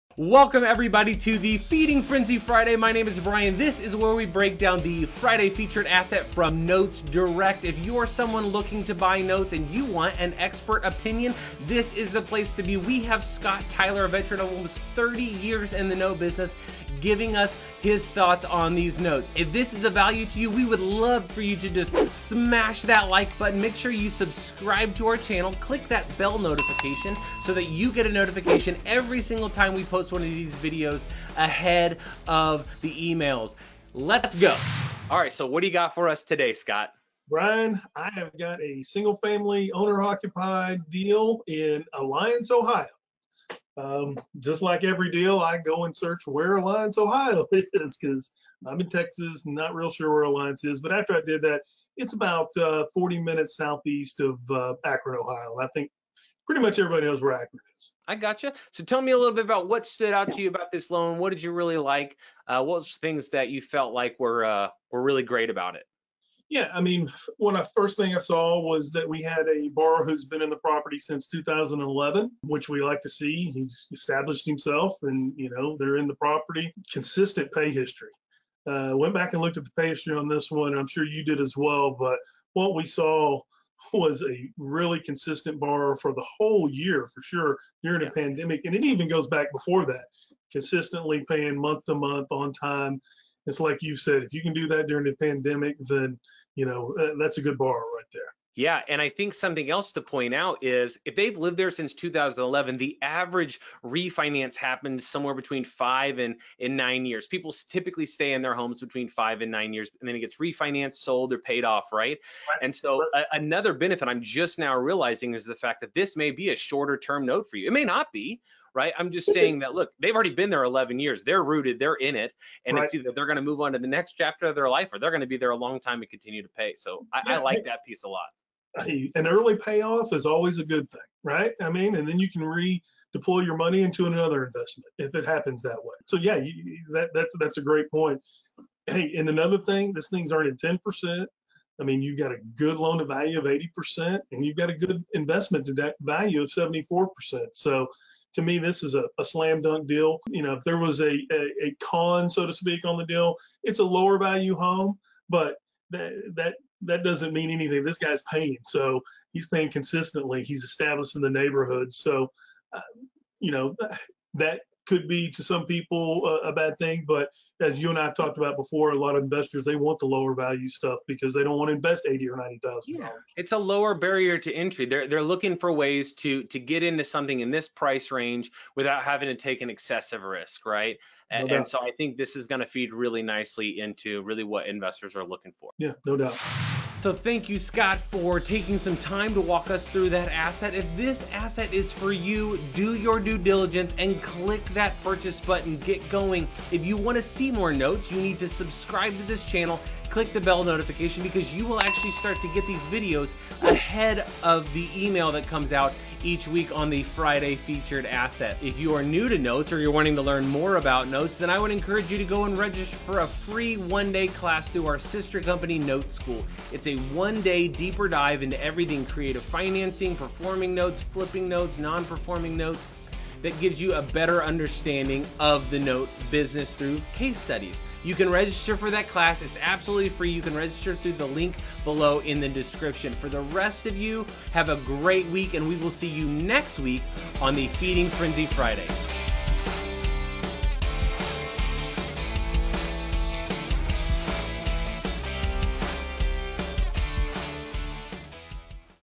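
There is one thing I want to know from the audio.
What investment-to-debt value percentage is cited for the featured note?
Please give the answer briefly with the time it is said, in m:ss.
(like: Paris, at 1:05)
74%, at 2:26.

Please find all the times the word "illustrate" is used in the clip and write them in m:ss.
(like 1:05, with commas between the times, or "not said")
not said.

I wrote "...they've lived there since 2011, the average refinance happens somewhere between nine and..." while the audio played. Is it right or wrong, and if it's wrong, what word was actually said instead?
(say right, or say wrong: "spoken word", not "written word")
wrong: "five", not "nine".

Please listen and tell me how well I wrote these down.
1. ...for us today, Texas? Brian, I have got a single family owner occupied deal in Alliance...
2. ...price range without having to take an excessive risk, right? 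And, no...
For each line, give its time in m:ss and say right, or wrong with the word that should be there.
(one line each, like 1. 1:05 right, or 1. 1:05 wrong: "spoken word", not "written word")
1. 0:35 wrong: "Scott", not "Texas"
2. 2:57 right.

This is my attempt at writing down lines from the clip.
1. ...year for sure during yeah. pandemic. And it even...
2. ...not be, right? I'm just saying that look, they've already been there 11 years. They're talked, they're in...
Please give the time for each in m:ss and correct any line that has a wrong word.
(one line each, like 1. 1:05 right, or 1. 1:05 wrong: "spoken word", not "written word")
1. 1:26 right
2. 1:57 wrong: "rooted", not "talked".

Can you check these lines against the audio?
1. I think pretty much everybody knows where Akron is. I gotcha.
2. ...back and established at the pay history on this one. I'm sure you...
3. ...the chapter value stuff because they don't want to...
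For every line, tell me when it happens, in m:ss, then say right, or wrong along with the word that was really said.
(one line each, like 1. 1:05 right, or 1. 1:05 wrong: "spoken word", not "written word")
1. 0:55 right
2. 1:19 wrong: "looked", not "established"
3. 2:49 wrong: "lower", not "chapter".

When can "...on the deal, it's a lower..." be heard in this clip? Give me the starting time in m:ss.
2:32.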